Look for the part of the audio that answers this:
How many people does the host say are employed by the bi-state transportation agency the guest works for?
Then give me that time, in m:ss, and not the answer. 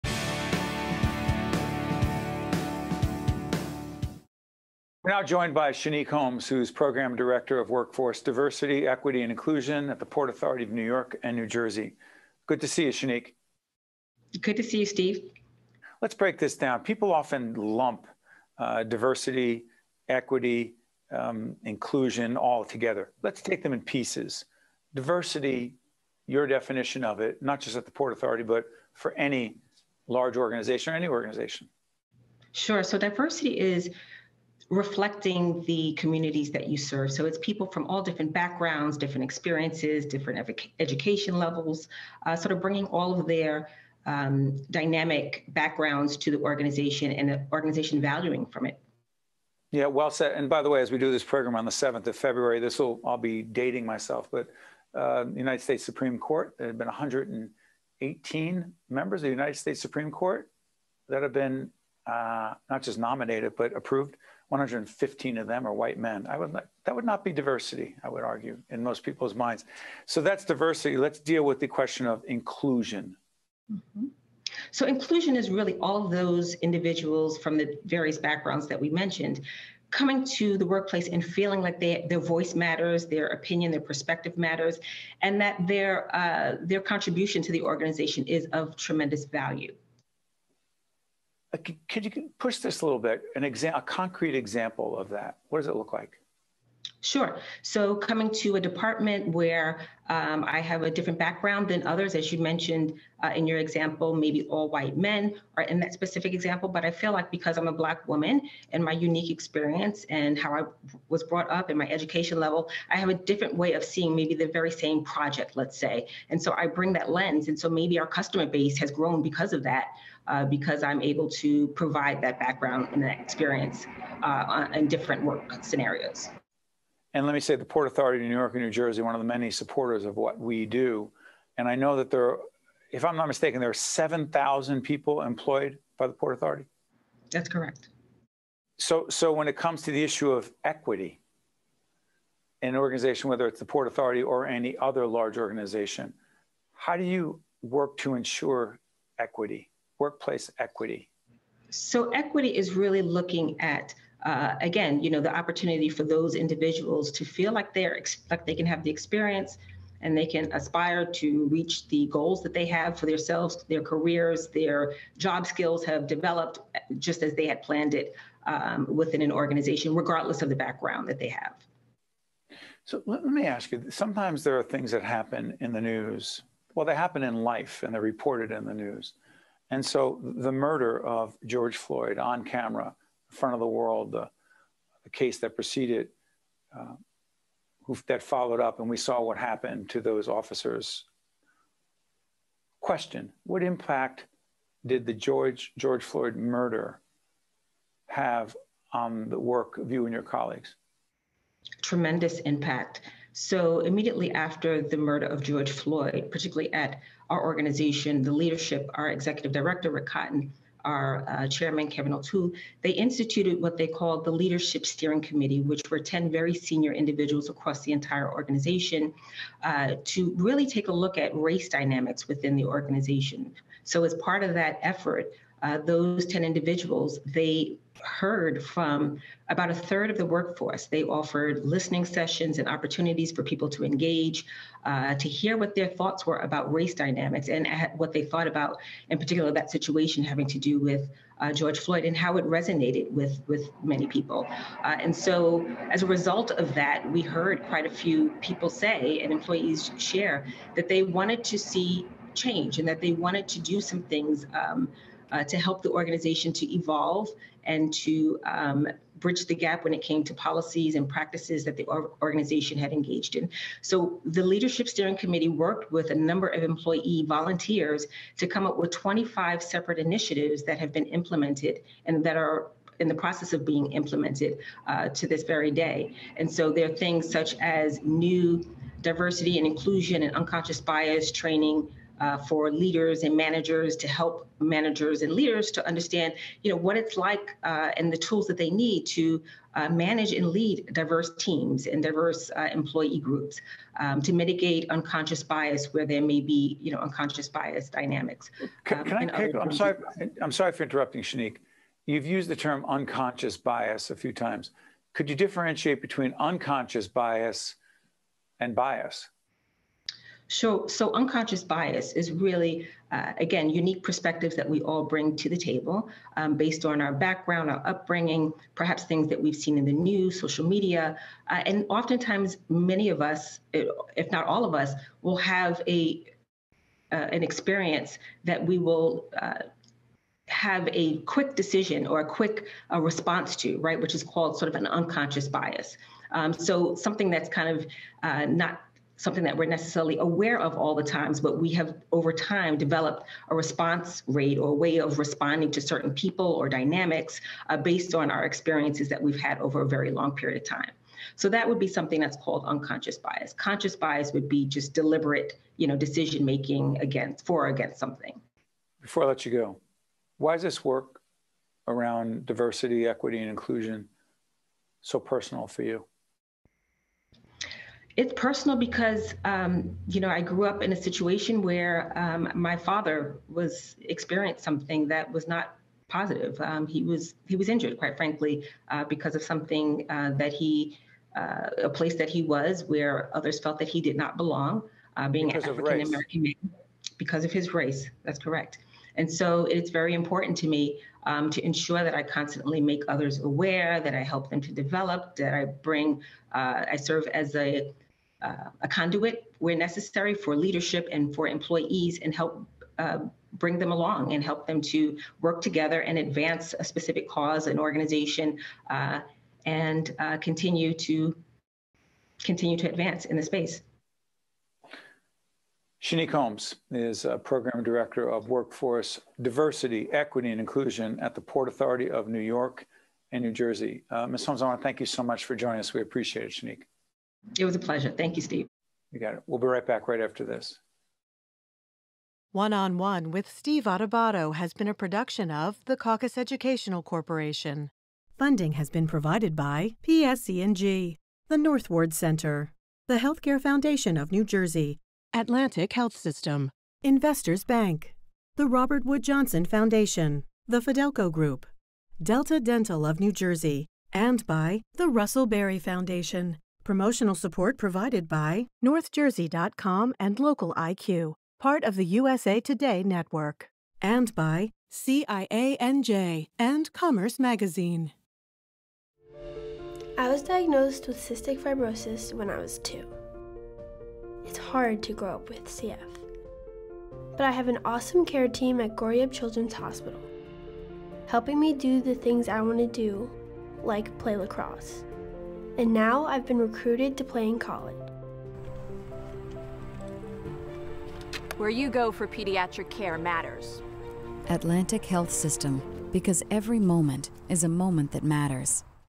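2:13.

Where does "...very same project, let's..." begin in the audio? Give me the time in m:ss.
1:54.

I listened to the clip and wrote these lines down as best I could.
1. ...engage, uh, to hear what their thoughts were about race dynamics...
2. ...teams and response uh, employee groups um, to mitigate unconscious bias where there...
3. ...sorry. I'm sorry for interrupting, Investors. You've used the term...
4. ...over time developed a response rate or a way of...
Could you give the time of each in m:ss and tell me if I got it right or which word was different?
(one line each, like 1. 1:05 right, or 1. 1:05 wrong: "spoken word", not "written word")
1. 3:53 right
2. 4:51 wrong: "diverse", not "response"
3. 4:59 wrong: "Shanique", not "Investors"
4. 5:42 right.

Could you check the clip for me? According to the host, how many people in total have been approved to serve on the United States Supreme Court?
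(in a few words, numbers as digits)
118.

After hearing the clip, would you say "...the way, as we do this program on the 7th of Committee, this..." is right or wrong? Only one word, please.
wrong.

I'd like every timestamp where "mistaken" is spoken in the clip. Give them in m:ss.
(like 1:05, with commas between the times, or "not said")
2:13.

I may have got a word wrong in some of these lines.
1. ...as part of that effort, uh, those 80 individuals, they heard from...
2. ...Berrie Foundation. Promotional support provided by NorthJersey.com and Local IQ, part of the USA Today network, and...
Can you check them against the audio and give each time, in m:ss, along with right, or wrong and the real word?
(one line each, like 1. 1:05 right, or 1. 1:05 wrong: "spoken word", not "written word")
1. 3:44 wrong: "10", not "80"
2. 7:35 right.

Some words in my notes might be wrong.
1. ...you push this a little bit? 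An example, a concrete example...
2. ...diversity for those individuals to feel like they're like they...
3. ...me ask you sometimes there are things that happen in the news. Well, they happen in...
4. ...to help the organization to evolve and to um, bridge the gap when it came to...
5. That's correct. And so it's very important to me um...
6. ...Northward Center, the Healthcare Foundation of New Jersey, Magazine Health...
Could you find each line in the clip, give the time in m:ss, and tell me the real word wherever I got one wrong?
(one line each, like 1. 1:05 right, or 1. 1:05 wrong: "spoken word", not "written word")
1. 1:32 right
2. 2:35 wrong: "opportunity", not "diversity"
3. 2:53 right
4. 4:15 right
5. 6:28 right
6. 7:21 wrong: "Atlantic", not "Magazine".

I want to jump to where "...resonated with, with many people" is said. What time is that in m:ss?
4:02.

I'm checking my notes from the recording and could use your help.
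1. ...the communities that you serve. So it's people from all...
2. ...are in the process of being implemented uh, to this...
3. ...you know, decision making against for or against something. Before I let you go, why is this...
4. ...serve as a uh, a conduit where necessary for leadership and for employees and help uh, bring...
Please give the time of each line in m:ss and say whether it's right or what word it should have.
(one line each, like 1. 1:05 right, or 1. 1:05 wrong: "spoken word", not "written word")
1. 0:35 right
2. 4:32 right
3. 5:55 right
4. 6:36 right.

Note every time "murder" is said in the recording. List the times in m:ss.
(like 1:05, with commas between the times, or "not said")
3:00, 3:16, 3:24.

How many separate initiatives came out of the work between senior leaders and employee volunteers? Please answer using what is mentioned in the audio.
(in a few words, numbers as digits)
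25.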